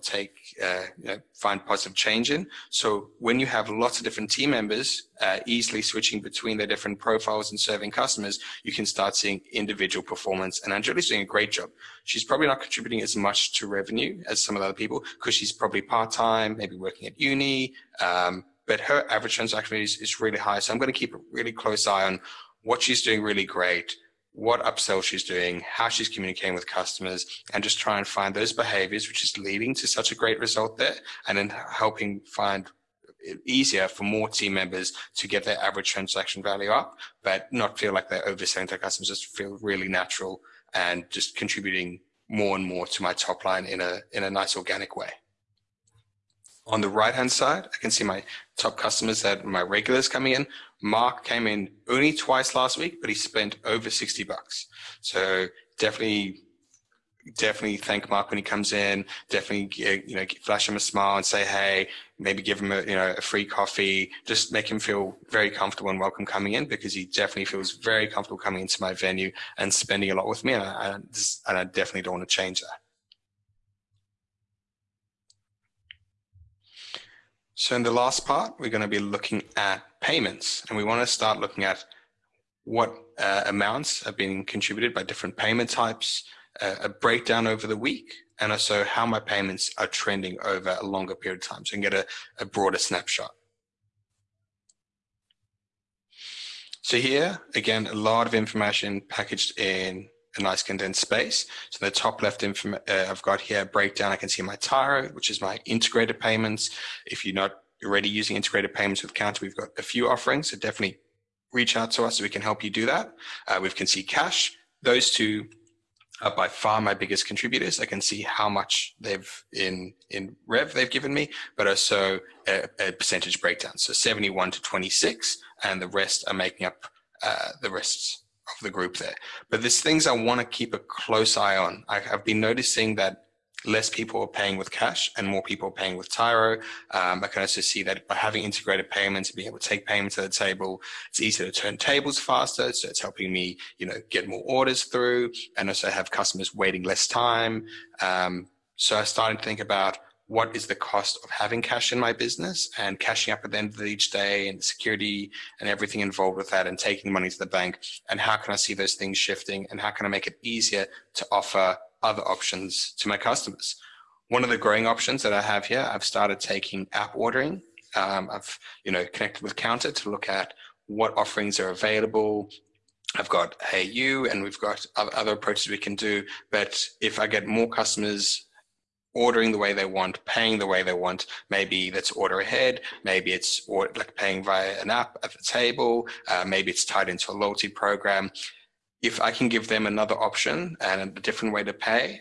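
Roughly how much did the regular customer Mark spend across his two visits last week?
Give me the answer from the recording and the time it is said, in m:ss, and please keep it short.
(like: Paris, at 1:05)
over $60, at 0:53.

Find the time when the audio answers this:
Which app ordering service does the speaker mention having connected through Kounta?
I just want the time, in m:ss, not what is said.
2:53.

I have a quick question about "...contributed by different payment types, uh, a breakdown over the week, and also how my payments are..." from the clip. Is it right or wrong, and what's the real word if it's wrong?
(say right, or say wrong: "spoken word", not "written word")
right.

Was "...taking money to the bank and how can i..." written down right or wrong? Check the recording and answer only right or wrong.
right.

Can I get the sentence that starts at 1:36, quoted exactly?
So here, again, a lot of information packaged in a nice condensed space.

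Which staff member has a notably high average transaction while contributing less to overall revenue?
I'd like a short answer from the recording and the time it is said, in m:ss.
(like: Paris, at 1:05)
Angelica, at 0:10.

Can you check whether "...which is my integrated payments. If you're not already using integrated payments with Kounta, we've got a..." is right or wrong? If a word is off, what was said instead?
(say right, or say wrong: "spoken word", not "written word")
right.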